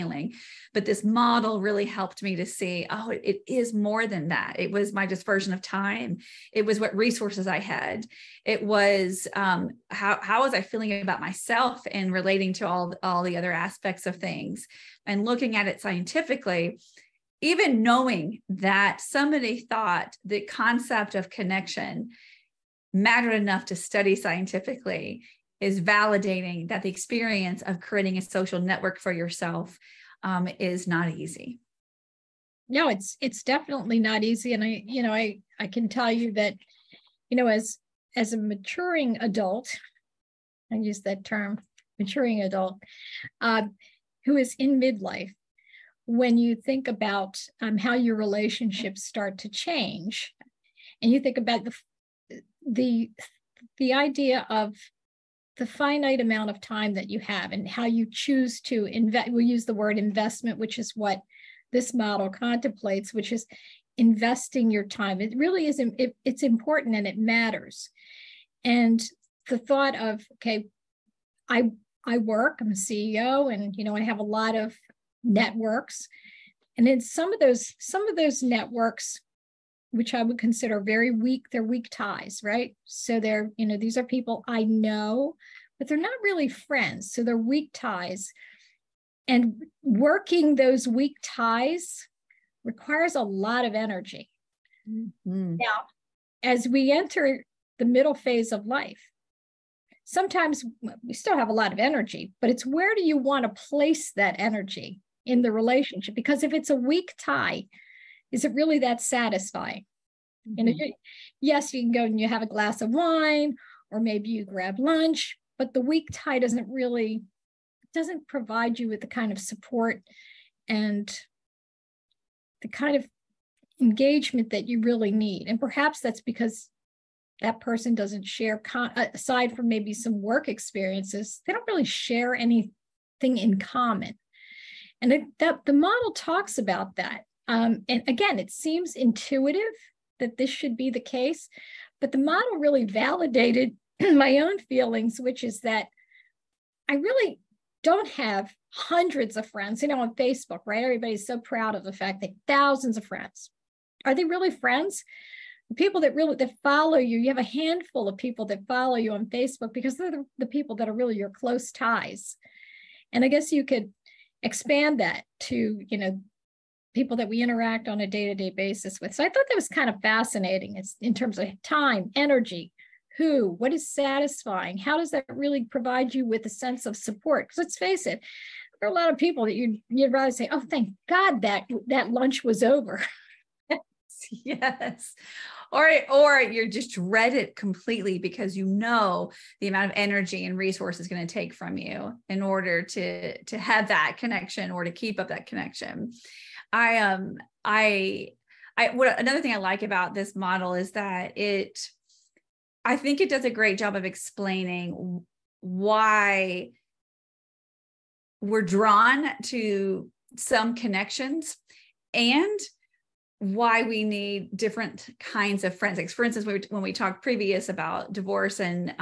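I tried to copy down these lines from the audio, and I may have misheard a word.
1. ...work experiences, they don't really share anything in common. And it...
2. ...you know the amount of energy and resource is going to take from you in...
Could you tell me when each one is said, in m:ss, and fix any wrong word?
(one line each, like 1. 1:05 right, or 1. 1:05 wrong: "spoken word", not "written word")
1. 2:10 right
2. 3:08 right.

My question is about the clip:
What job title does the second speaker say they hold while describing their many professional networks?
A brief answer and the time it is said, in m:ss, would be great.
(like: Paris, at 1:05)
CEO, at 1:12.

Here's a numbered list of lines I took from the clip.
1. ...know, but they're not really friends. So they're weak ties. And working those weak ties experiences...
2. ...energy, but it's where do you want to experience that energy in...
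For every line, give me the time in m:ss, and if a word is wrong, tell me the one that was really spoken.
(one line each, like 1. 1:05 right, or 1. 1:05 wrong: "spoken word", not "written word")
1. 1:24 wrong: "requires", not "experiences"
2. 1:41 wrong: "place", not "experience".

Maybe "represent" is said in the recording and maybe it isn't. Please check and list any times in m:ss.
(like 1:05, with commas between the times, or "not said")
not said.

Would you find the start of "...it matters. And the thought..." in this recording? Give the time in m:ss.
1:07.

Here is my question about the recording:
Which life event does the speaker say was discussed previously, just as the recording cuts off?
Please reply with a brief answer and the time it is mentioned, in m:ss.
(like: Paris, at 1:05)
divorce, at 3:38.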